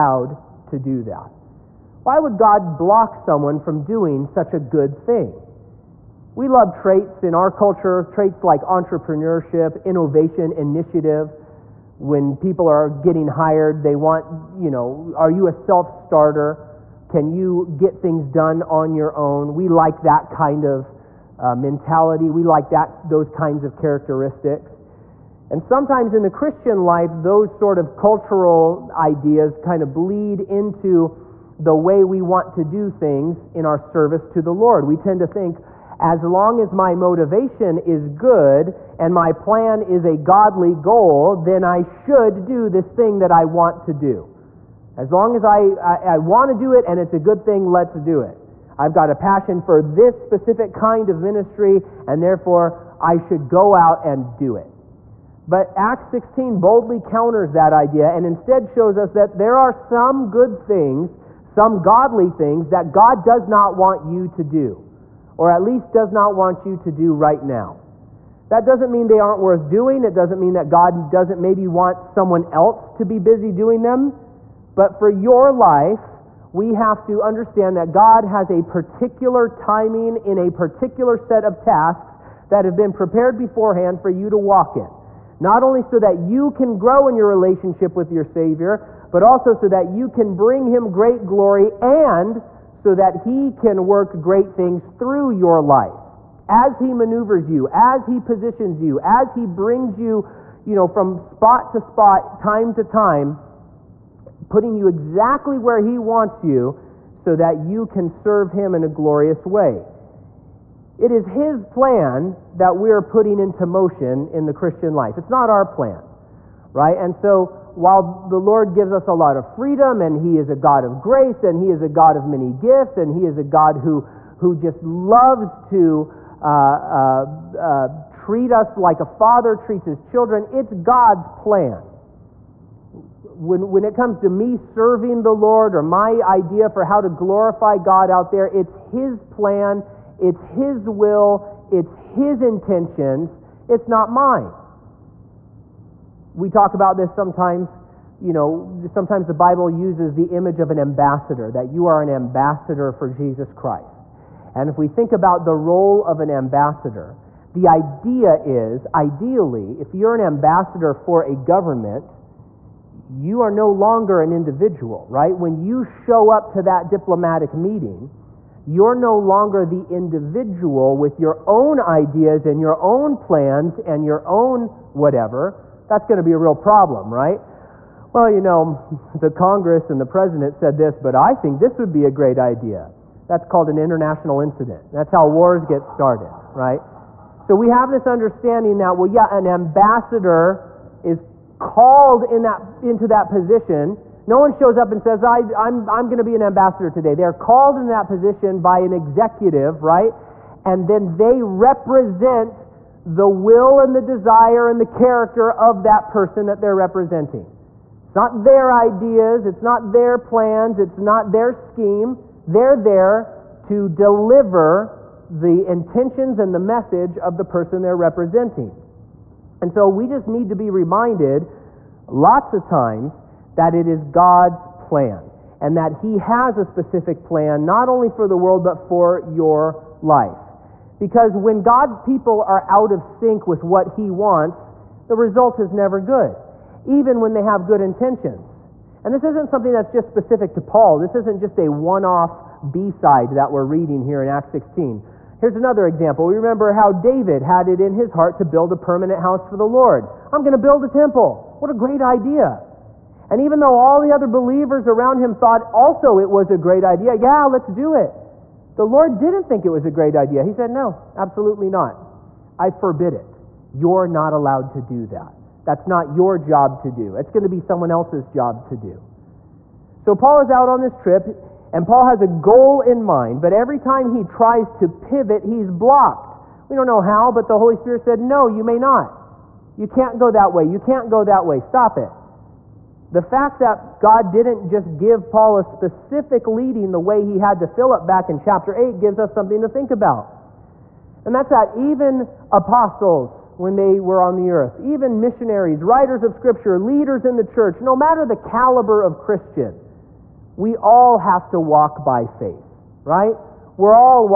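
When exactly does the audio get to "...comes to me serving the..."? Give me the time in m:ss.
2:13.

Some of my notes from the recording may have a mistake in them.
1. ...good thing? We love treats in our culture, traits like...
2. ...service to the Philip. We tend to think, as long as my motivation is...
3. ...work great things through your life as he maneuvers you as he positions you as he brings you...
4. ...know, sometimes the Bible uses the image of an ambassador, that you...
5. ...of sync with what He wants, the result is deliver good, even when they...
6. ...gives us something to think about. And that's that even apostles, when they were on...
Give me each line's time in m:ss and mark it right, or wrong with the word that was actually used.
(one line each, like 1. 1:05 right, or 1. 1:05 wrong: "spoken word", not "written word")
1. 0:04 wrong: "traits", not "treats"
2. 0:33 wrong: "Lord", not "Philip"
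3. 1:33 right
4. 2:28 right
5. 3:52 wrong: "never", not "deliver"
6. 4:48 right.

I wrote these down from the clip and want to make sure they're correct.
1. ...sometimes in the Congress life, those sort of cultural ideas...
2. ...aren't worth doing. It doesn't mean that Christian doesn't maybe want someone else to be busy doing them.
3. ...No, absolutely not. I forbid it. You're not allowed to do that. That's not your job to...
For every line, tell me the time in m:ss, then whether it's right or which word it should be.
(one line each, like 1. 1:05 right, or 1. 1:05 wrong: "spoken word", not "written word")
1. 0:25 wrong: "Christian", not "Congress"
2. 1:09 wrong: "God", not "Christian"
3. 4:20 right.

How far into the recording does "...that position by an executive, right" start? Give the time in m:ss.
3:17.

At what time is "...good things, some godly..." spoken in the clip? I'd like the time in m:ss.
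1:00.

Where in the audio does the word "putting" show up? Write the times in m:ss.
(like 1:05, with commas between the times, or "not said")
1:44, 1:53.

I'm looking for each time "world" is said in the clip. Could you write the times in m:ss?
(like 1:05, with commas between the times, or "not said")
3:48.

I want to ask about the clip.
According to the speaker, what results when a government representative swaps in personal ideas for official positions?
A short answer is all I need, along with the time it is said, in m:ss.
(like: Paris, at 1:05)
An international incident, at 3:03.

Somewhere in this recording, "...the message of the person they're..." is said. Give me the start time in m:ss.
3:36.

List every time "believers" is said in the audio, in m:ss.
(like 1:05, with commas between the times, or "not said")
4:14.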